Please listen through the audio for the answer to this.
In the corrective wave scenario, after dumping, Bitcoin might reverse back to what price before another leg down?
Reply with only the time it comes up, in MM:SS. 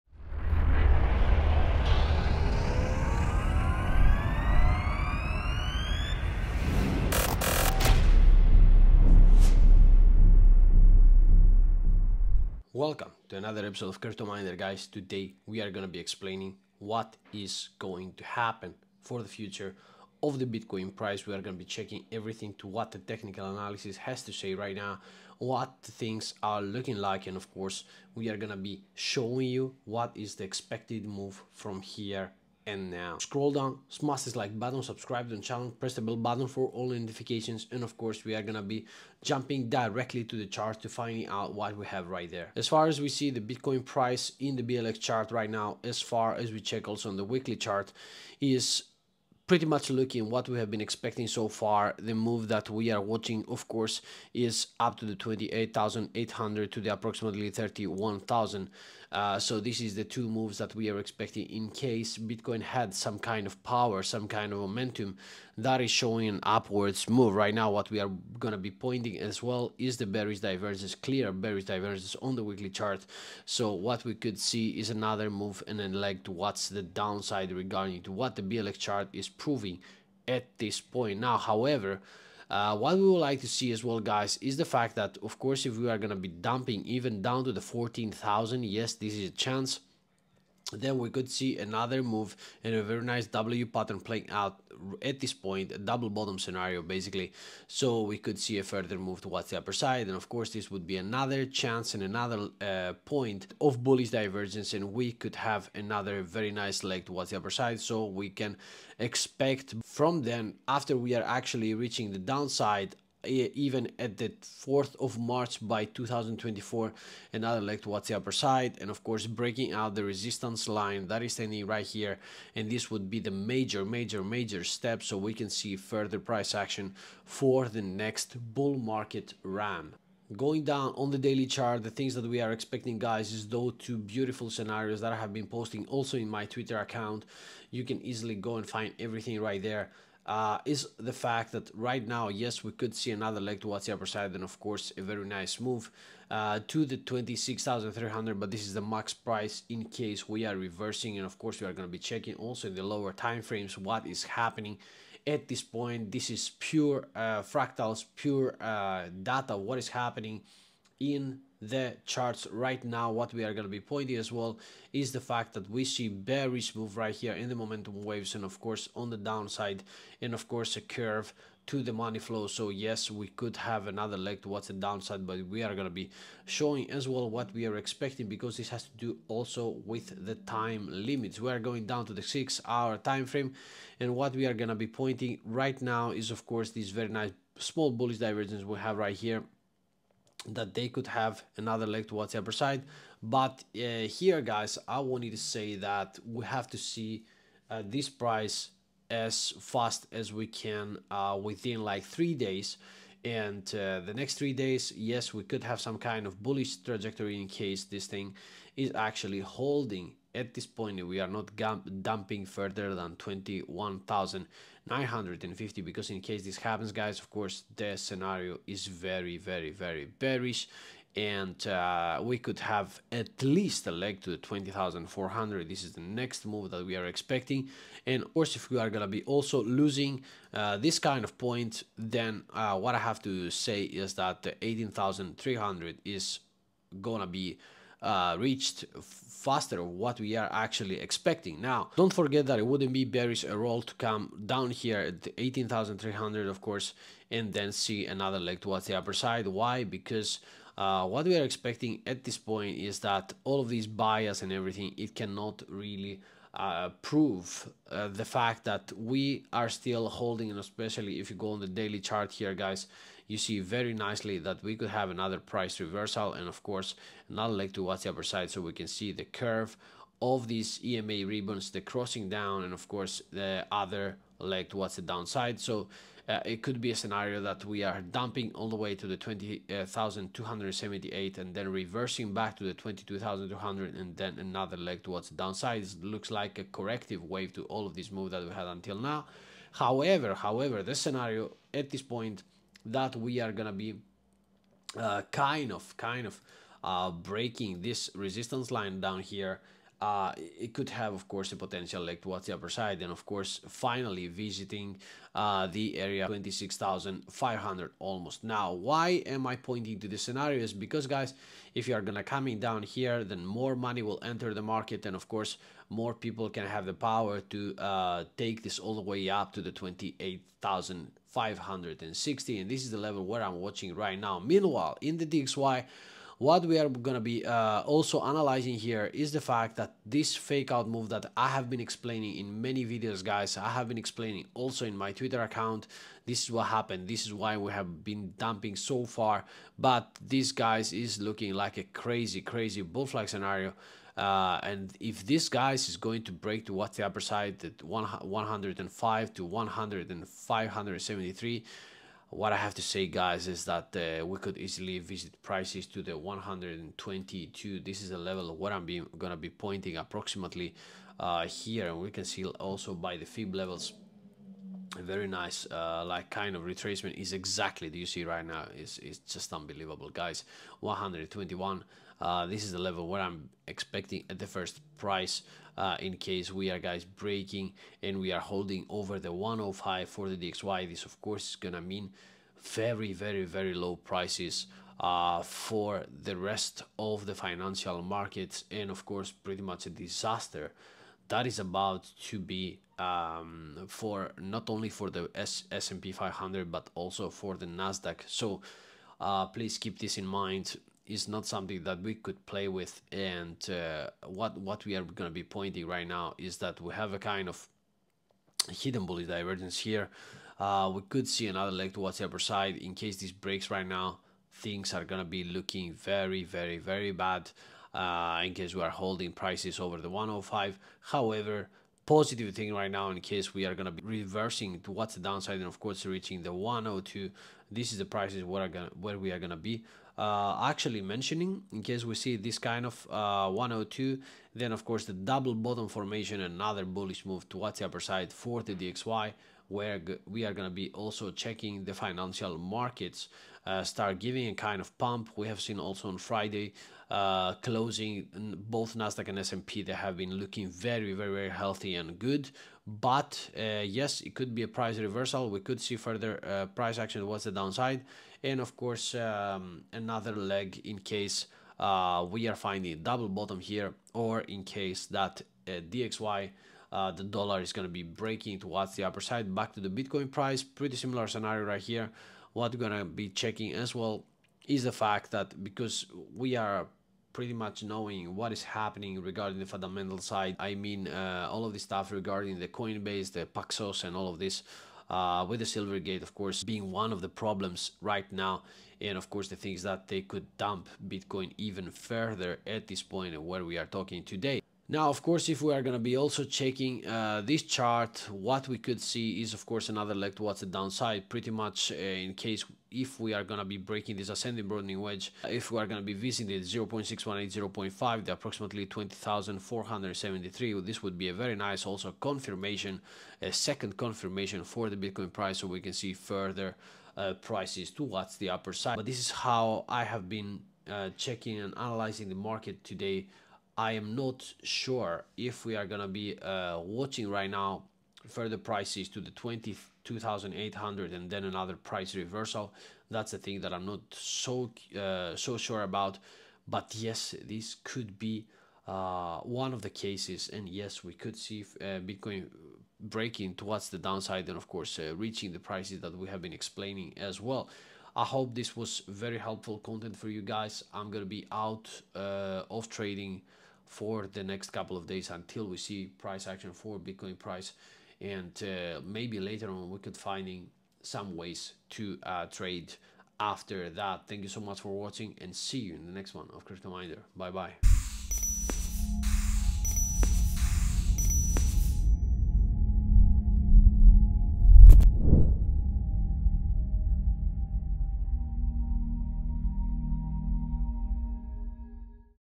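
04:42.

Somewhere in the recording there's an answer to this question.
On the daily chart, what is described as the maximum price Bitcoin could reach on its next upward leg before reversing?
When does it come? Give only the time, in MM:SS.
02:26.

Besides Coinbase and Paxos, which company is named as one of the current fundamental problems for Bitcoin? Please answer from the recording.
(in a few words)
Silvergate.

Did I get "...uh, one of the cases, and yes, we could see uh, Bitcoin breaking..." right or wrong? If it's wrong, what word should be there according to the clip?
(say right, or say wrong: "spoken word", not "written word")
right.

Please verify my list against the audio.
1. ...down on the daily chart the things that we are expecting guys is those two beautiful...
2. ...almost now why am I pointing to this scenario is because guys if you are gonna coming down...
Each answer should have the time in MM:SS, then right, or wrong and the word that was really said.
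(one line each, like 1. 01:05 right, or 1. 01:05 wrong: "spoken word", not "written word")
1. 02:10 right
2. 05:07 right.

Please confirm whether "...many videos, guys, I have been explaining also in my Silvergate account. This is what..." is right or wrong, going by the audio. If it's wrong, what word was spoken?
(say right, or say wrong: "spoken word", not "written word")
wrong: "Twitter", not "Silvergate".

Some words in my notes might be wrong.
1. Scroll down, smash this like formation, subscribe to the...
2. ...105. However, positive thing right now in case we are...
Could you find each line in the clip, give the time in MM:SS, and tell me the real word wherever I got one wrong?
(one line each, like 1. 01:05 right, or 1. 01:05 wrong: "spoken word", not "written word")
1. 00:33 wrong: "button", not "formation"
2. 07:00 right.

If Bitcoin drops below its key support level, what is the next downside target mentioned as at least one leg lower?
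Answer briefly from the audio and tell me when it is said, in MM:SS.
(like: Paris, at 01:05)
20,400, at 03:44.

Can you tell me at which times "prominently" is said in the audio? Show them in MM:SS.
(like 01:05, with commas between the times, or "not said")
not said.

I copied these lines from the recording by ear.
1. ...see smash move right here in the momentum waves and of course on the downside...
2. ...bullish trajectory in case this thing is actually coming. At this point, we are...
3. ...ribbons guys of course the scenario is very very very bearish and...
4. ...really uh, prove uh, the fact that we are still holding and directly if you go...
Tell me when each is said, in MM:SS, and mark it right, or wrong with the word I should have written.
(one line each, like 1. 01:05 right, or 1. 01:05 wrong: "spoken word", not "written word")
1. 02:45 wrong: "bearish", not "smash"
2. 03:26 wrong: "holding", not "coming"
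3. 03:36 wrong: "happens", not "ribbons"
4. 04:15 wrong: "especially", not "directly".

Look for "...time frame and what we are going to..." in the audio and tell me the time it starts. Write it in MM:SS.
03:02.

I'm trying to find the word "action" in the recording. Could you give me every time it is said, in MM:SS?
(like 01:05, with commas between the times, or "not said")
02:06, 07:36, 09:16.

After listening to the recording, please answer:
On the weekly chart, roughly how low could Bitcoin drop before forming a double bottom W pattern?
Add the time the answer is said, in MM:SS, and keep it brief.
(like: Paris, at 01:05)
14,000, at 01:27.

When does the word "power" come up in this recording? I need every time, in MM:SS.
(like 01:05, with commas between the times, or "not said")
01:03, 05:16.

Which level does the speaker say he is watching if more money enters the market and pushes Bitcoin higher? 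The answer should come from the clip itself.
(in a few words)
28,560.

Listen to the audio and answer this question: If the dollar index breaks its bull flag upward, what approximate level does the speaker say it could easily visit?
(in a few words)
122.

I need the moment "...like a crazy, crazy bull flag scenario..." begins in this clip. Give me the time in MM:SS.
05:41.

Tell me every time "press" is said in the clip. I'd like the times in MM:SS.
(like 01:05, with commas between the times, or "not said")
00:35.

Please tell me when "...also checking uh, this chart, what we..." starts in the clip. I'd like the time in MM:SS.
08:16.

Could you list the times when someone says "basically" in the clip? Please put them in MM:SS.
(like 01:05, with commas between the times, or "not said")
01:36.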